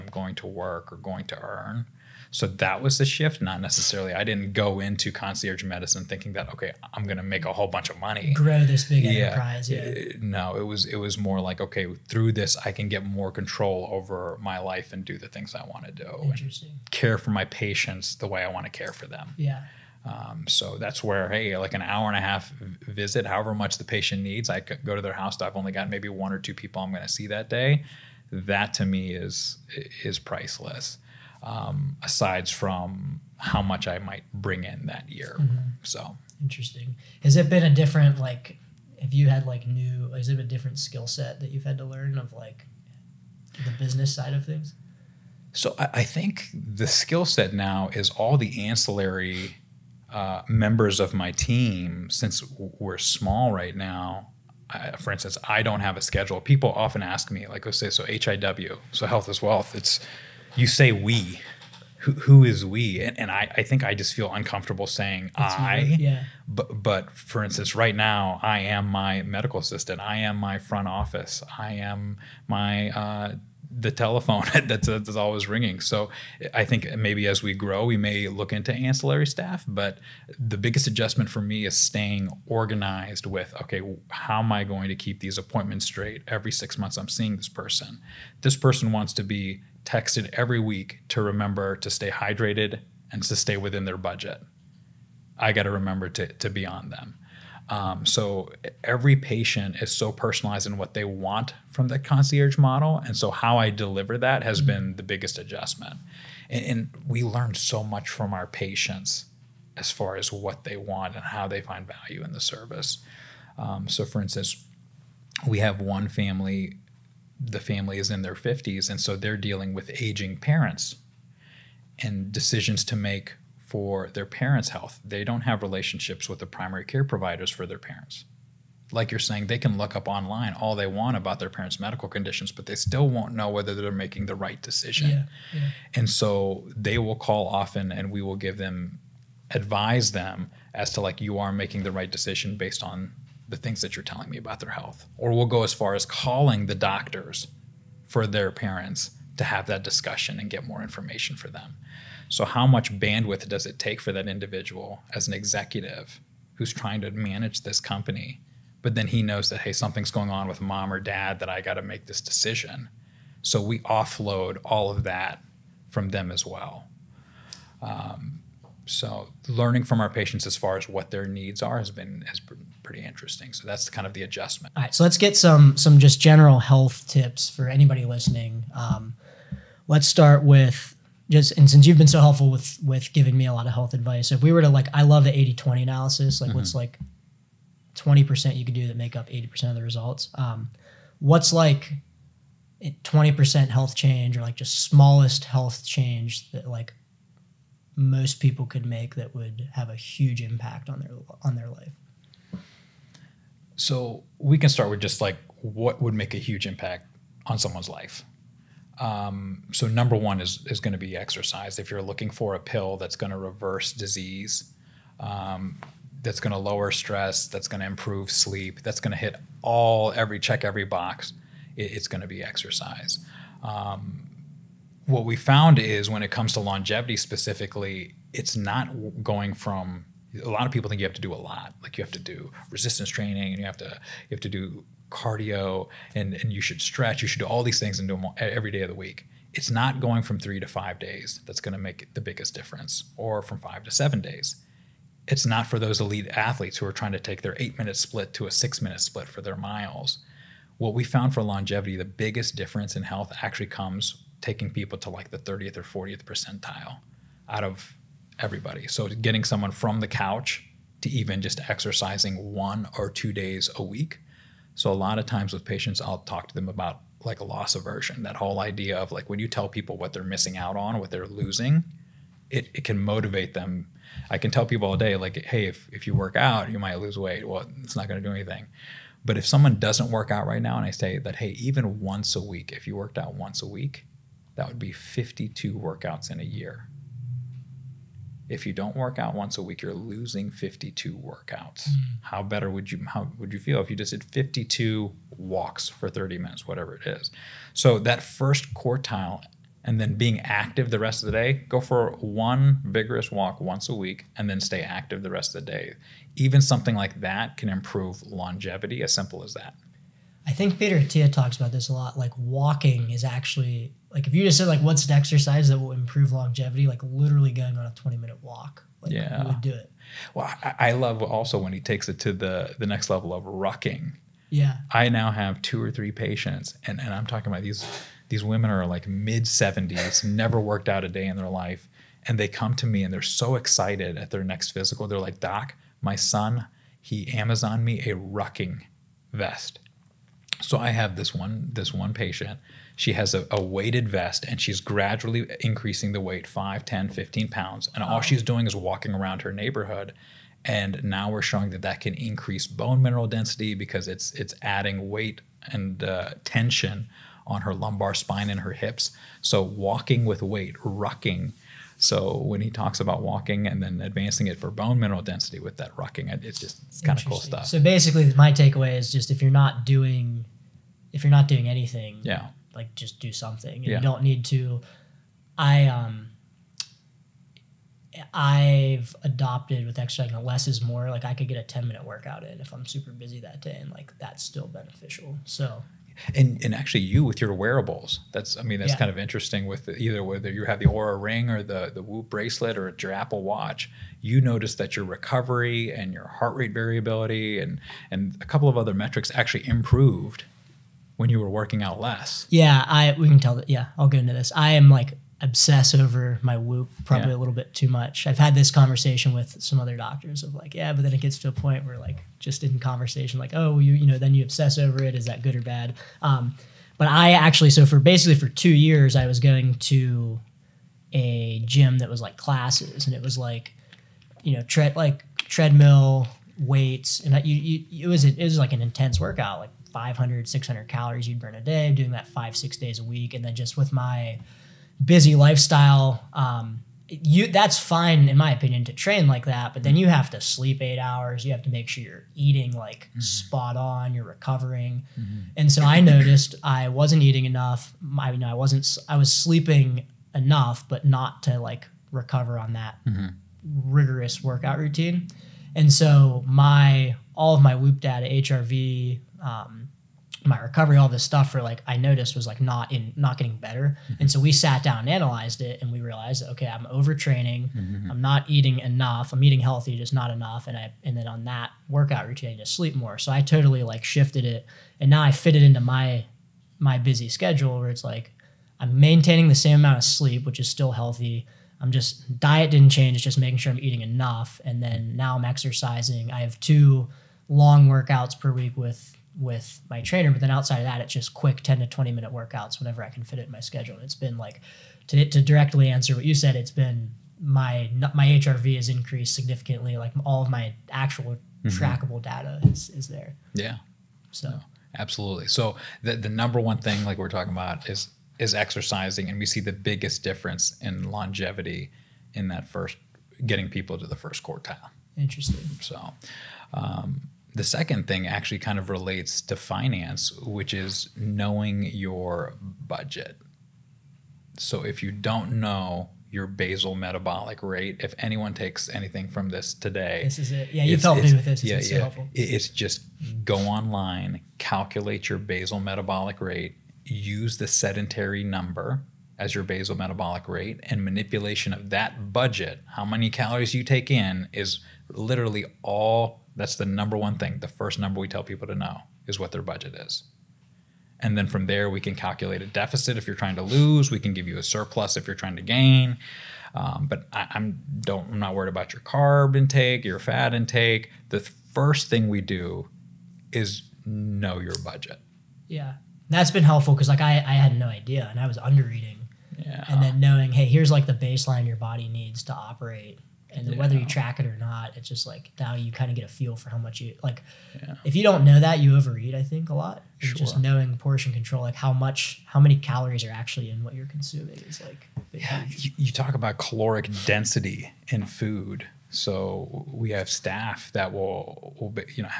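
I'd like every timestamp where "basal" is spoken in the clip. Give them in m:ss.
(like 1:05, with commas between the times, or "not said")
8:46, 8:55, 8:59.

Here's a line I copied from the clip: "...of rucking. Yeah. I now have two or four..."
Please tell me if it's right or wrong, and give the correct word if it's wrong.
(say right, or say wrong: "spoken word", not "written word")
wrong: "three", not "four".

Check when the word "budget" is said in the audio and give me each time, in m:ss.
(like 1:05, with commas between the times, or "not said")
1:33, 8:42, 9:02, 9:09, 9:24.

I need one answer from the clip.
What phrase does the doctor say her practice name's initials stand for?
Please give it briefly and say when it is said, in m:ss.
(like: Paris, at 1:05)
health is wealth, at 0:59.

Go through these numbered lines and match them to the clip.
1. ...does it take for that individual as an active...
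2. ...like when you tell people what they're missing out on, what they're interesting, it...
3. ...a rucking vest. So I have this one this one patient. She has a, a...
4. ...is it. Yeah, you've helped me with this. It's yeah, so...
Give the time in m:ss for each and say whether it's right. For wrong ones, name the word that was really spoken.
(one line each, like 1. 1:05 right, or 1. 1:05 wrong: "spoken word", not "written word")
1. 2:33 wrong: "executive", not "active"
2. 4:29 wrong: "losing", not "interesting"
3. 5:37 right
4. 8:50 right.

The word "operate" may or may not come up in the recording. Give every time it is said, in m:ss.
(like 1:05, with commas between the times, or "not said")
9:32.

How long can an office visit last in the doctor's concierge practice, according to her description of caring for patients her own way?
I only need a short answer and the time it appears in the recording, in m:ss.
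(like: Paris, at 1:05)
an hour and a half, at 0:21.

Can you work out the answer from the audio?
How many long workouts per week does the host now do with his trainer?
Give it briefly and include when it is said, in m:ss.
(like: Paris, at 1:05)
2, at 8:06.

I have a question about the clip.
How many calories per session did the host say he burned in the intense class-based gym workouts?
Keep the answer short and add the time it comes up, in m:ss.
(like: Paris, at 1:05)
500 to 600, at 7:09.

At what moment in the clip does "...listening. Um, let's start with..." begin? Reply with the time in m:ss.
2:58.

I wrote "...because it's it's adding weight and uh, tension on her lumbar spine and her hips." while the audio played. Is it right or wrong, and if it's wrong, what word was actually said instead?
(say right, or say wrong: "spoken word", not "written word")
right.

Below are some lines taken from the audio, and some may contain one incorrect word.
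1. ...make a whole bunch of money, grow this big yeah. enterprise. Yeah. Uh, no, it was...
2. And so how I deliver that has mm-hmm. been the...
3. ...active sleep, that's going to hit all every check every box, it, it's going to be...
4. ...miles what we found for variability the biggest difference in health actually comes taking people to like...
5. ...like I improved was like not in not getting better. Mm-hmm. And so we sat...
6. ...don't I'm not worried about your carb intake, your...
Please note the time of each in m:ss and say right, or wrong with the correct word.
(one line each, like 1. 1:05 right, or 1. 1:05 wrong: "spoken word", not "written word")
1. 0:07 right
2. 1:43 right
3. 3:37 wrong: "improve", not "active"
4. 4:09 wrong: "longevity", not "variability"
5. 7:41 wrong: "noticed", not "improved"
6. 9:18 right.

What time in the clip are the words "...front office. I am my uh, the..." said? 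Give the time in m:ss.
1:10.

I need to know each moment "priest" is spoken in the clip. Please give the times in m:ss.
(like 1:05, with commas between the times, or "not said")
not said.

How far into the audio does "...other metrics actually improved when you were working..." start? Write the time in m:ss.
6:38.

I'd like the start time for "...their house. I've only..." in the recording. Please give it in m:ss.
0:25.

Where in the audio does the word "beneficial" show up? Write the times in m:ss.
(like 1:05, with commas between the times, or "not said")
6:24.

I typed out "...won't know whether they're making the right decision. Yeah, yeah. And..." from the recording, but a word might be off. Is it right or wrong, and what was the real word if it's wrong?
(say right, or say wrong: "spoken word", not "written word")
right.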